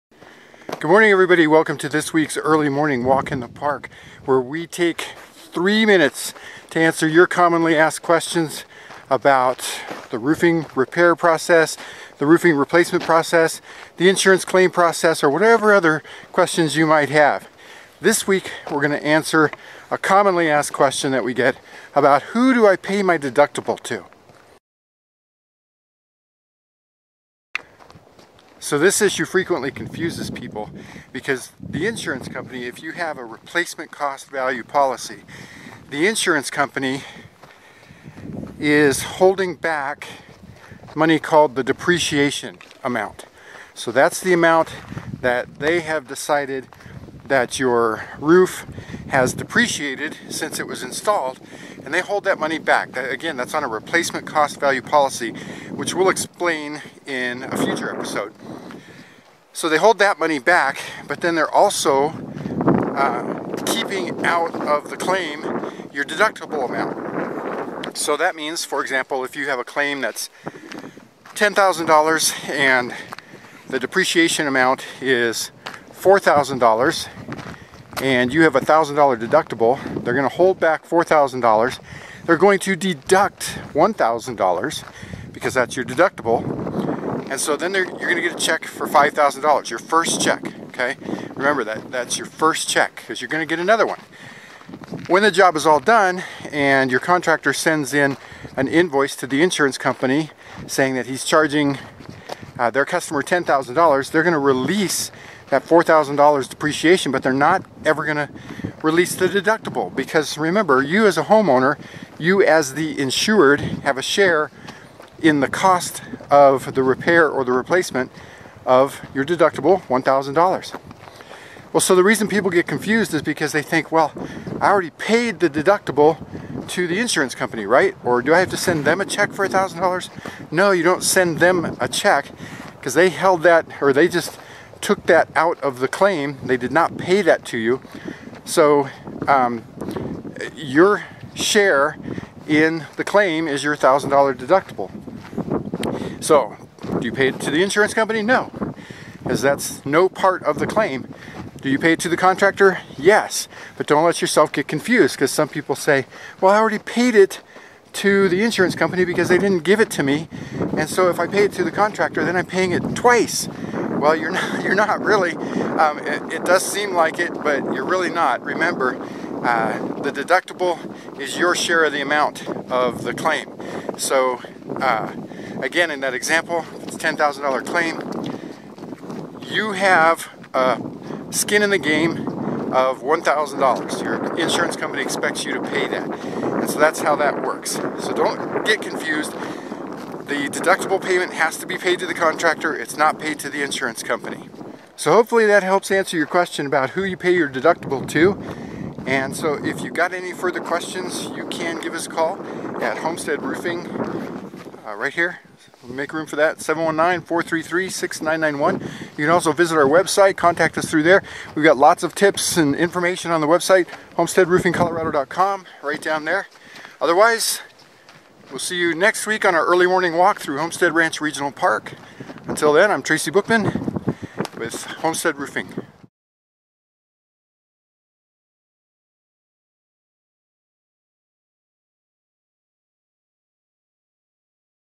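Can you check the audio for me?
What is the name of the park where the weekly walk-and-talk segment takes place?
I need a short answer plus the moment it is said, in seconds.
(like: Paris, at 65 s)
Homestead Ranch Regional Park, at 220 s.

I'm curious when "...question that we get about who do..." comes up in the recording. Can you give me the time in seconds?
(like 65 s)
20 s.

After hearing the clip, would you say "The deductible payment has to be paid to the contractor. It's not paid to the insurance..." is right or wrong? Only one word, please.
right.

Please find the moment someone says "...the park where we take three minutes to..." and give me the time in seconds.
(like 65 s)
3 s.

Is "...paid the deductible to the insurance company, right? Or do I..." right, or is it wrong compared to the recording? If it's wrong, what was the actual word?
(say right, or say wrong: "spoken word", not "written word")
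right.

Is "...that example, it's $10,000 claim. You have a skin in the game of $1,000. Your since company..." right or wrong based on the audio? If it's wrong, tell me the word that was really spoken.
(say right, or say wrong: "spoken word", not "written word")
wrong: "insurance", not "since".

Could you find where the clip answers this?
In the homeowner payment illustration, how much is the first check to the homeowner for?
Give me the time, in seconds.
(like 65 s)
88 s.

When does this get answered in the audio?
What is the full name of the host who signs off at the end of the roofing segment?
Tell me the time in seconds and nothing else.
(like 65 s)
223 s.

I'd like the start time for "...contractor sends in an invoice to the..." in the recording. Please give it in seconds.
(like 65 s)
96 s.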